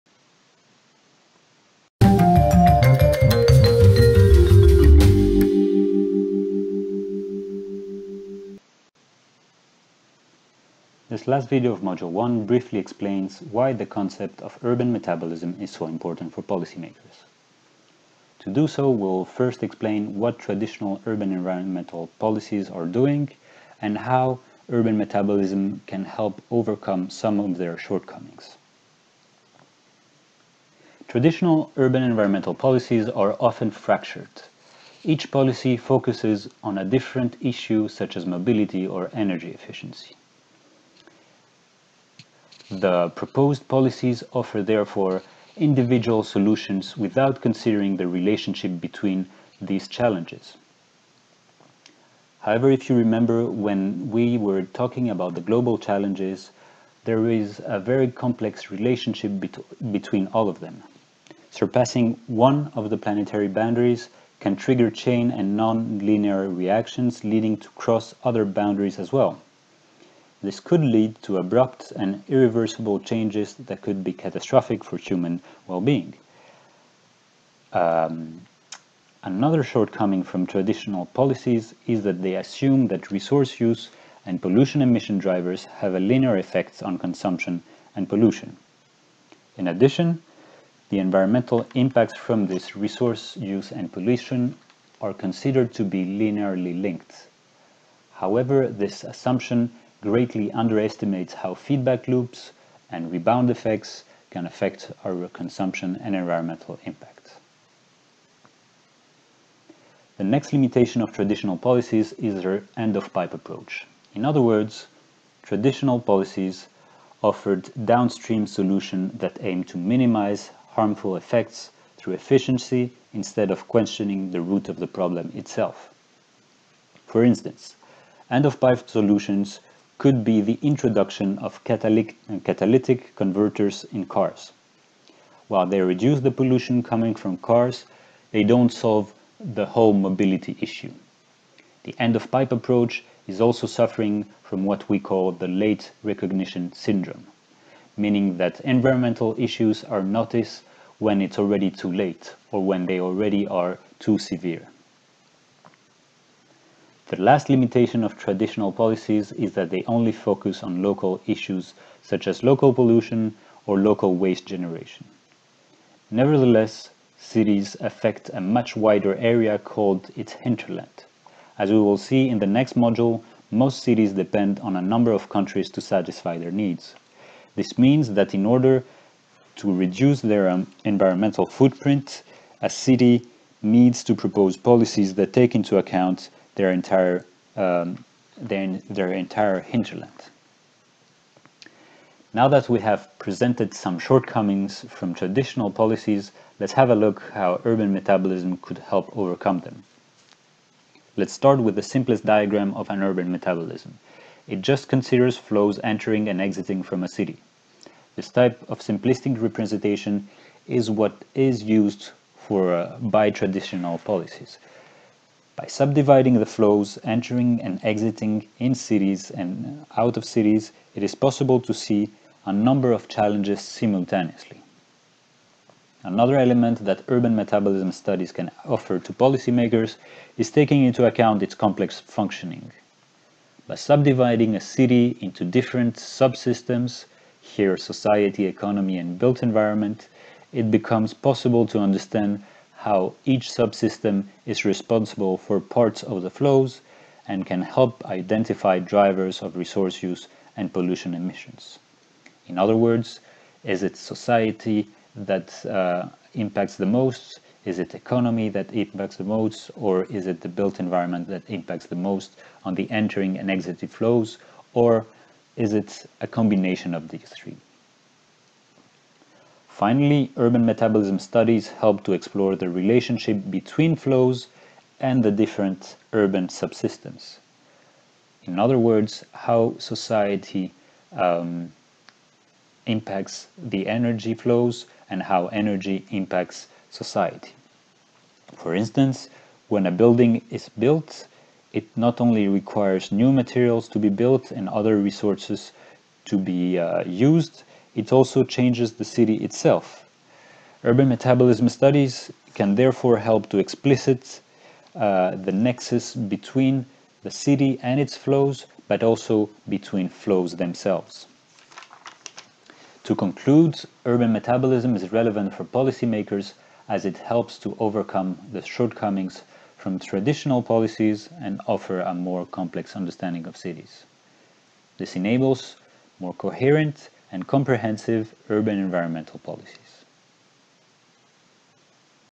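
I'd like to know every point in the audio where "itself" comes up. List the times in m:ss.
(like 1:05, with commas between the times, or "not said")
2:05, 4:59.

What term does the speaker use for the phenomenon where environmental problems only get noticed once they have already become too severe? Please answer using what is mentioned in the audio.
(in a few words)
late recognition syndrome.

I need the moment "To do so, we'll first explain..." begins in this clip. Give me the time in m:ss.
0:18.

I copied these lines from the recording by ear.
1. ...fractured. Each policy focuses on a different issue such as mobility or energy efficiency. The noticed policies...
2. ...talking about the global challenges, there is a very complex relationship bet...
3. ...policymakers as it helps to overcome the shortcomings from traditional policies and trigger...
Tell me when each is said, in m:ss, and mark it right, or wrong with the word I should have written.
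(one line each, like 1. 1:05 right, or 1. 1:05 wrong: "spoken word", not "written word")
1. 0:33 wrong: "proposed", not "noticed"
2. 0:54 right
3. 5:15 wrong: "offer", not "trigger".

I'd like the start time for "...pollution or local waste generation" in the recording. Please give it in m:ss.
2:42.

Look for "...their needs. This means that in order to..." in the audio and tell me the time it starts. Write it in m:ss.
2:56.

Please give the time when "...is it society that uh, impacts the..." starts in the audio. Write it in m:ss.
4:13.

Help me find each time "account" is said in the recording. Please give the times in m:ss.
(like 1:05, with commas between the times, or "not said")
3:05, 3:51.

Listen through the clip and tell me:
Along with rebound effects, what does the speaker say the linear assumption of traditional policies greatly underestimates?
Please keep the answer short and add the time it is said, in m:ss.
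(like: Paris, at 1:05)
feedback loops, at 1:41.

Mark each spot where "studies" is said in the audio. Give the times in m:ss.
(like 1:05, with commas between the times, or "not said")
3:47, 4:31, 5:01.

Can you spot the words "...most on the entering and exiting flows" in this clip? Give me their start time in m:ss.
4:22.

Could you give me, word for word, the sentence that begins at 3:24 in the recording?
It just considers flows entering and exiting from a city.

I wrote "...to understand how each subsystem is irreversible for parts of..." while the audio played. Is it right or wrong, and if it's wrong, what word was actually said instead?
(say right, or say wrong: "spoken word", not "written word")
wrong: "responsible", not "irreversible".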